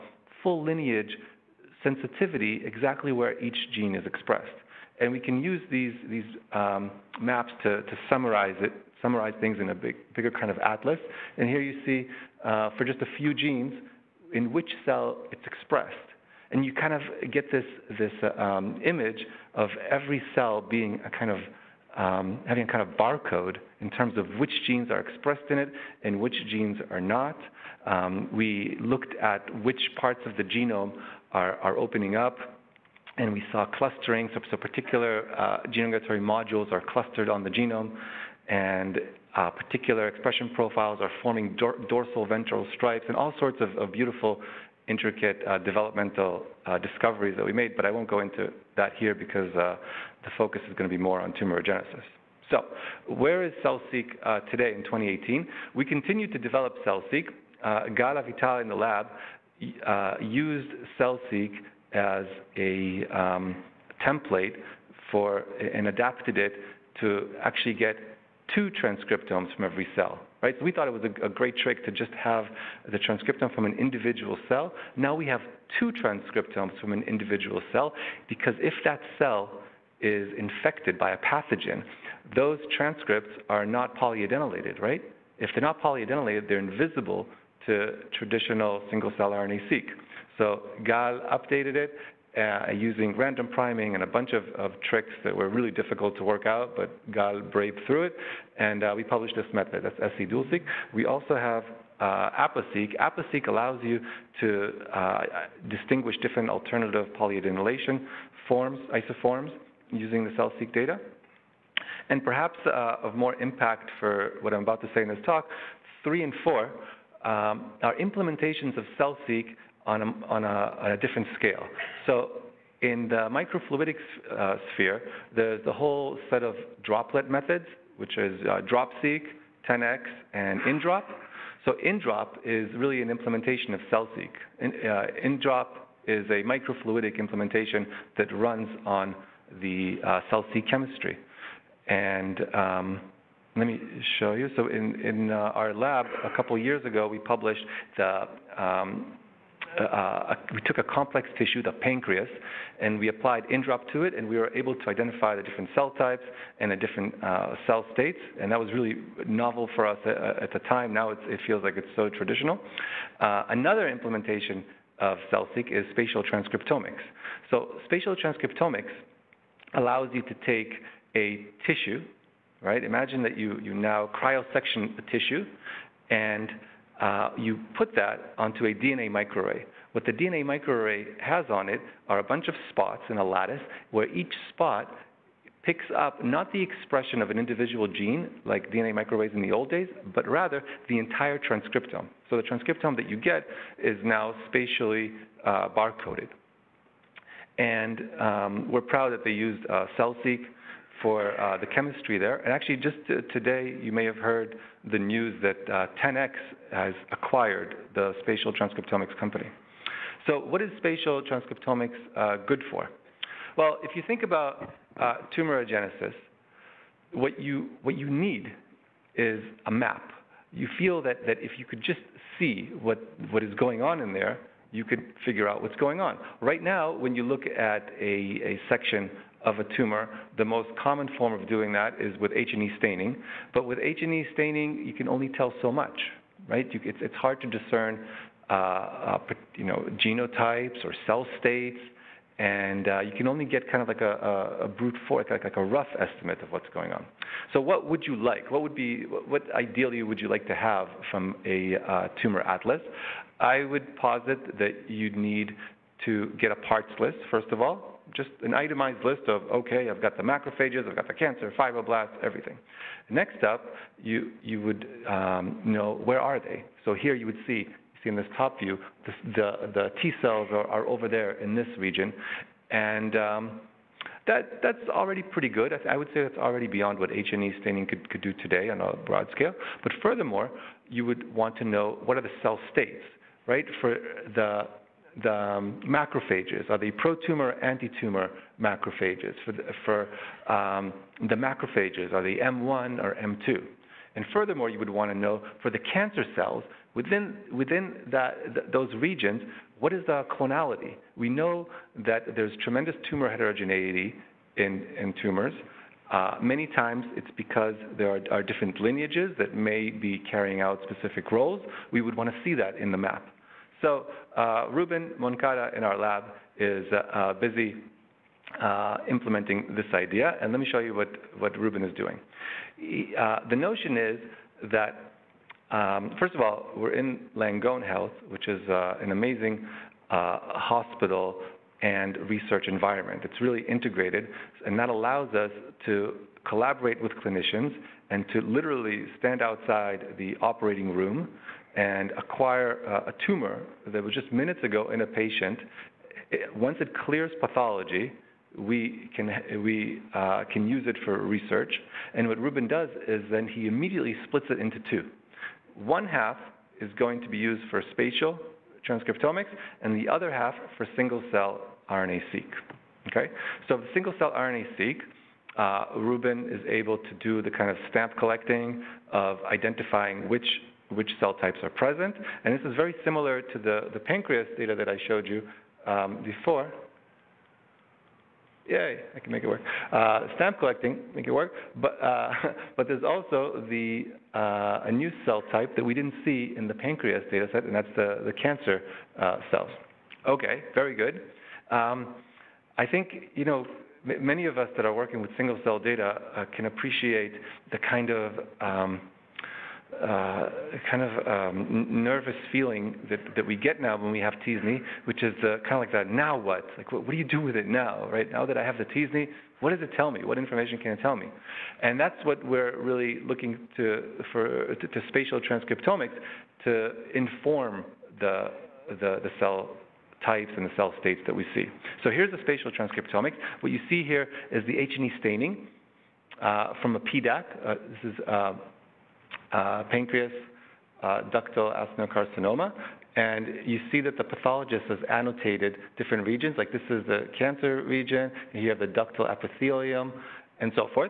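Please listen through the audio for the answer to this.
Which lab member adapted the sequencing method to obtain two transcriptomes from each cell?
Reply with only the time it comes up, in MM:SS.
00:57.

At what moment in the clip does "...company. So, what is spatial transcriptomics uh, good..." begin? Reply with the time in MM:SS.
03:29.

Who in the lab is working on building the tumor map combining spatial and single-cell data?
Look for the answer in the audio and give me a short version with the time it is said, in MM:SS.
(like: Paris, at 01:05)
Ruben Moncada, at 05:14.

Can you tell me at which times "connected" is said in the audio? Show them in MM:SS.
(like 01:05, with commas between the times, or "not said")
not said.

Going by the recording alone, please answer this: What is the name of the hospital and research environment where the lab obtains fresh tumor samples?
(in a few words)
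Langone Health.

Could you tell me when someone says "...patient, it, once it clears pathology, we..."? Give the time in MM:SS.
05:45.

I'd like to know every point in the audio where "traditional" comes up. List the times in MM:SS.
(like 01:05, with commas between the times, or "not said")
01:28, 02:42.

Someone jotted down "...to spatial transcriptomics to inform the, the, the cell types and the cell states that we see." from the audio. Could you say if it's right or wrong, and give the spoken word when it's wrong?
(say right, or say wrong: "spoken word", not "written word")
right.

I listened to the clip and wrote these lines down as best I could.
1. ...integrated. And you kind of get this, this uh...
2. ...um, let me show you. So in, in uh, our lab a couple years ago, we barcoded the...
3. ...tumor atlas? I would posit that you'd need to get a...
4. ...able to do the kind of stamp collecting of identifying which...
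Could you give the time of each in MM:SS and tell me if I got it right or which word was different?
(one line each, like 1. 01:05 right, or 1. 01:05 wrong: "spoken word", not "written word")
1. 00:15 wrong: "expressed", not "integrated"
2. 02:22 wrong: "published", not "barcoded"
3. 04:12 right
4. 06:06 right.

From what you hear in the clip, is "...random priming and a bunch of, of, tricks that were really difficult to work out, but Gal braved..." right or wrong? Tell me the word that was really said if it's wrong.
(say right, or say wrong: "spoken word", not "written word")
right.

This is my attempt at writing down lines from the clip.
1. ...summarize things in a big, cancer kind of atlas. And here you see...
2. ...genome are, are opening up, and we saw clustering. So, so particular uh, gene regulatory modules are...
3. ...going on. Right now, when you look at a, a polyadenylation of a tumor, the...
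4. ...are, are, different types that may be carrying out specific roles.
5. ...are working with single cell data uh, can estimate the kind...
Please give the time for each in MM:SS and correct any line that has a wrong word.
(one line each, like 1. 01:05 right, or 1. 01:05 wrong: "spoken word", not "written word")
1. 00:09 wrong: "bigger", not "cancer"
2. 00:30 right
3. 03:45 wrong: "section", not "polyadenylation"
4. 05:08 wrong: "lineages", not "types"
5. 06:34 wrong: "appreciate", not "estimate".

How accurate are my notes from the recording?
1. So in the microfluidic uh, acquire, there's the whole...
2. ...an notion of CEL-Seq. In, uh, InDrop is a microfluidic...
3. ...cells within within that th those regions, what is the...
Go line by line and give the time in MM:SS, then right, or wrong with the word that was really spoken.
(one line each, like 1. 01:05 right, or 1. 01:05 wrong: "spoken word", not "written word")
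1. 02:02 wrong: "sphere", not "acquire"
2. 02:13 wrong: "implementation", not "notion"
3. 04:56 right.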